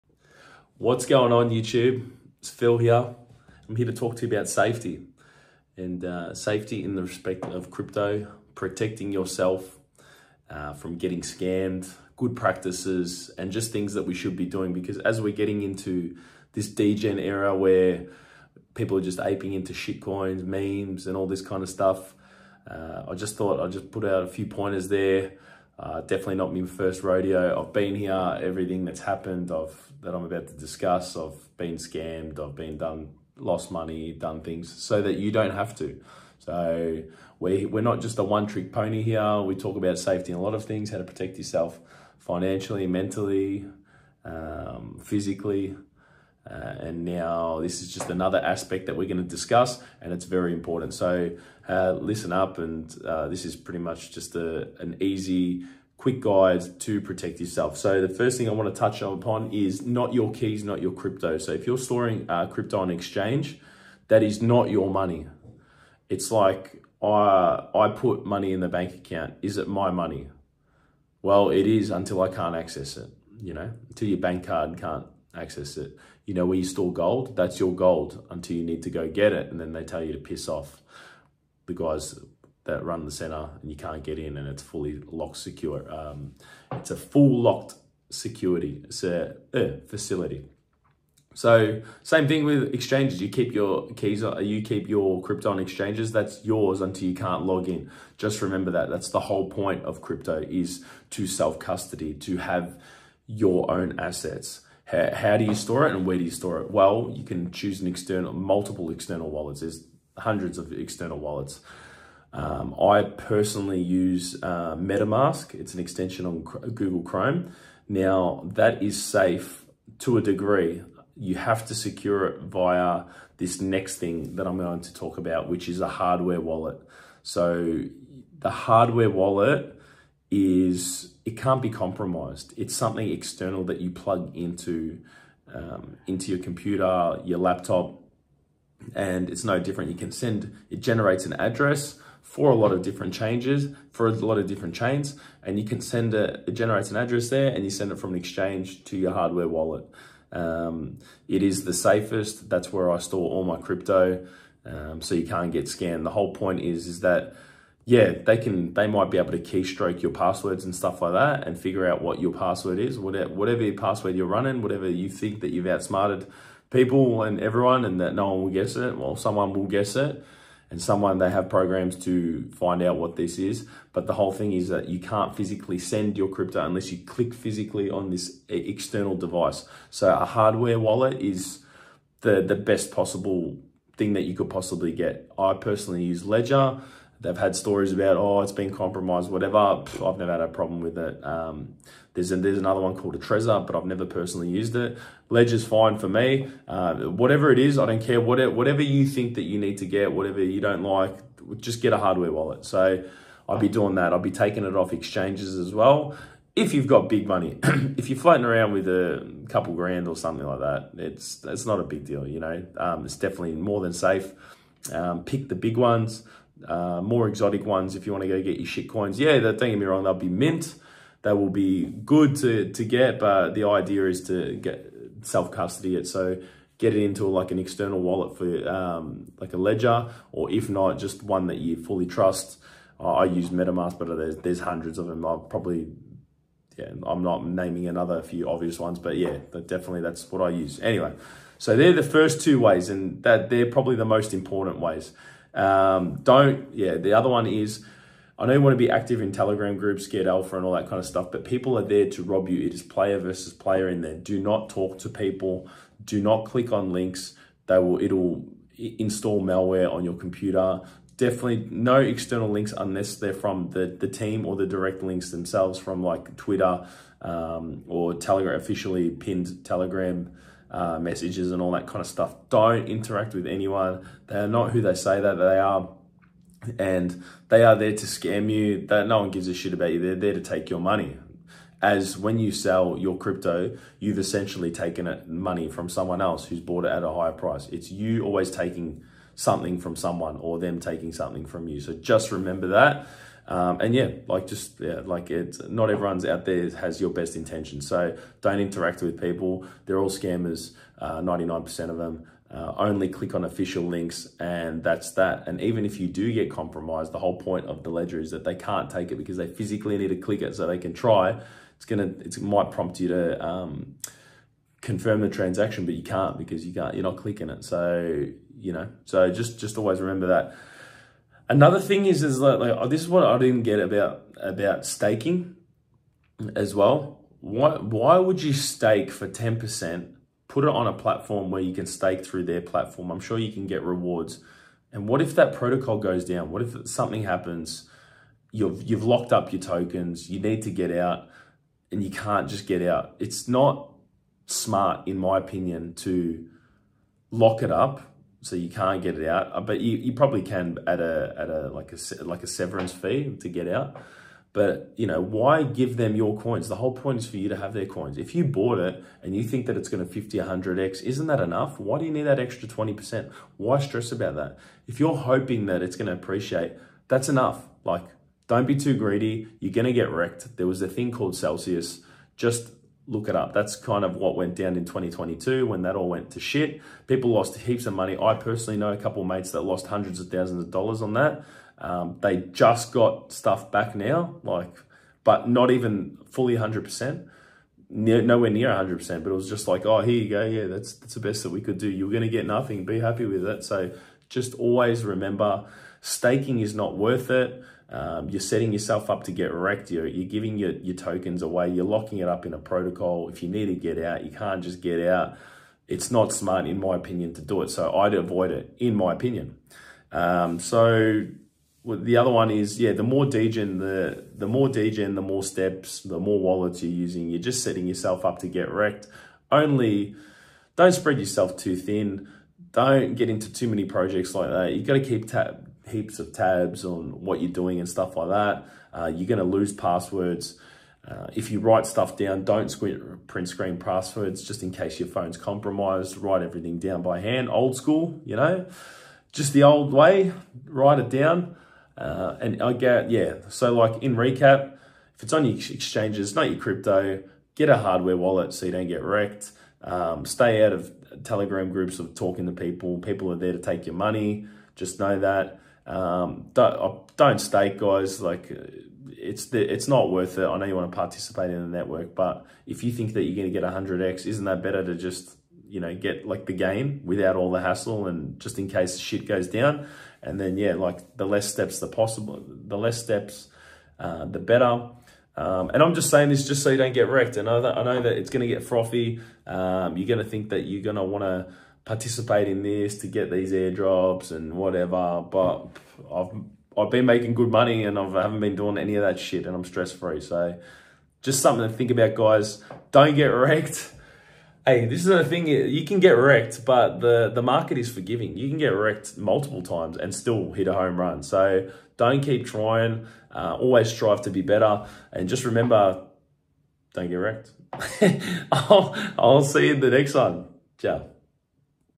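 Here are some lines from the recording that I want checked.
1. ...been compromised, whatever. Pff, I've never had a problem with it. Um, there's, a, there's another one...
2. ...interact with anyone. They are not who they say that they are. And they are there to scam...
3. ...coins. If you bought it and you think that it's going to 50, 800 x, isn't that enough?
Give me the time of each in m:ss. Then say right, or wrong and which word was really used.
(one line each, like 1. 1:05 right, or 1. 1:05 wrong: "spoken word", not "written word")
1. 3:08 right
2. 4:32 right
3. 5:57 wrong: "100", not "800".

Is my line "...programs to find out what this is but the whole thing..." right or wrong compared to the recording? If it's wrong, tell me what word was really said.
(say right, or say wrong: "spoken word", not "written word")
right.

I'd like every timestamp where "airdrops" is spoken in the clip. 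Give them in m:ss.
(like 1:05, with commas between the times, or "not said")
8:03.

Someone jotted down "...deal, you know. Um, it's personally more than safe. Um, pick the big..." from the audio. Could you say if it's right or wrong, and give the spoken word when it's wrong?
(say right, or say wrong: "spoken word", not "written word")
wrong: "definitely", not "personally".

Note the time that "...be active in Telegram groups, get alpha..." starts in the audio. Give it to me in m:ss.
4:08.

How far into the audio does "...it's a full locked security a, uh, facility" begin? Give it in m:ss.
1:26.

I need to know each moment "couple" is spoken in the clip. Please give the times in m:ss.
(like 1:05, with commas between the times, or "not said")
3:29, 6:18.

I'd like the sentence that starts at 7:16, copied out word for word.
Write everything down by hand, old school, you know, just the old way, write it down.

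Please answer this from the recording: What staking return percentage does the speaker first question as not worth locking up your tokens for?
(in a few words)
10%.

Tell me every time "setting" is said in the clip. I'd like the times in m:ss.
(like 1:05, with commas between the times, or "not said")
6:38, 6:57.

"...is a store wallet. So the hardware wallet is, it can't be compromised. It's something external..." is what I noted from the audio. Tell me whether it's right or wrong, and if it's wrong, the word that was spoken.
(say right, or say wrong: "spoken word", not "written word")
wrong: "hardware", not "store".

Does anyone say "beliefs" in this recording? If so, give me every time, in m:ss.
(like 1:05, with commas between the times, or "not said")
not said.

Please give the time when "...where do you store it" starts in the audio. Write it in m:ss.
1:46.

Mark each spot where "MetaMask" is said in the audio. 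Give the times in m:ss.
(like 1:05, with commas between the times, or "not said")
1:54, 3:53.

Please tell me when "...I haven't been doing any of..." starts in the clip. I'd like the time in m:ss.
8:08.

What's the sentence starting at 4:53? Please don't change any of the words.
Um, and yeah, like just yeah, like it's not everyone's out there has your best intention.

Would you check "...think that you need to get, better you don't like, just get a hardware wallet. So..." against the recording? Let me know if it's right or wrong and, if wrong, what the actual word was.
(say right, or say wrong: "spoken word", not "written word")
wrong: "whatever", not "better".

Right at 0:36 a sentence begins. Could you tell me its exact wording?
So we, we're not just a one trick pony here.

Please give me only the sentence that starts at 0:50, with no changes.
So uh, listen up and uh, this is pretty much just a, an easy quick guide to protect yourself.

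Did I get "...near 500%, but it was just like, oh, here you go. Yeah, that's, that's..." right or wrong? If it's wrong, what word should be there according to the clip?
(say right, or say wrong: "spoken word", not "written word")
wrong: "100", not "500".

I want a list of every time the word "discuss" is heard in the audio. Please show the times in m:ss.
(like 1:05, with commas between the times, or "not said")
0:30, 0:49.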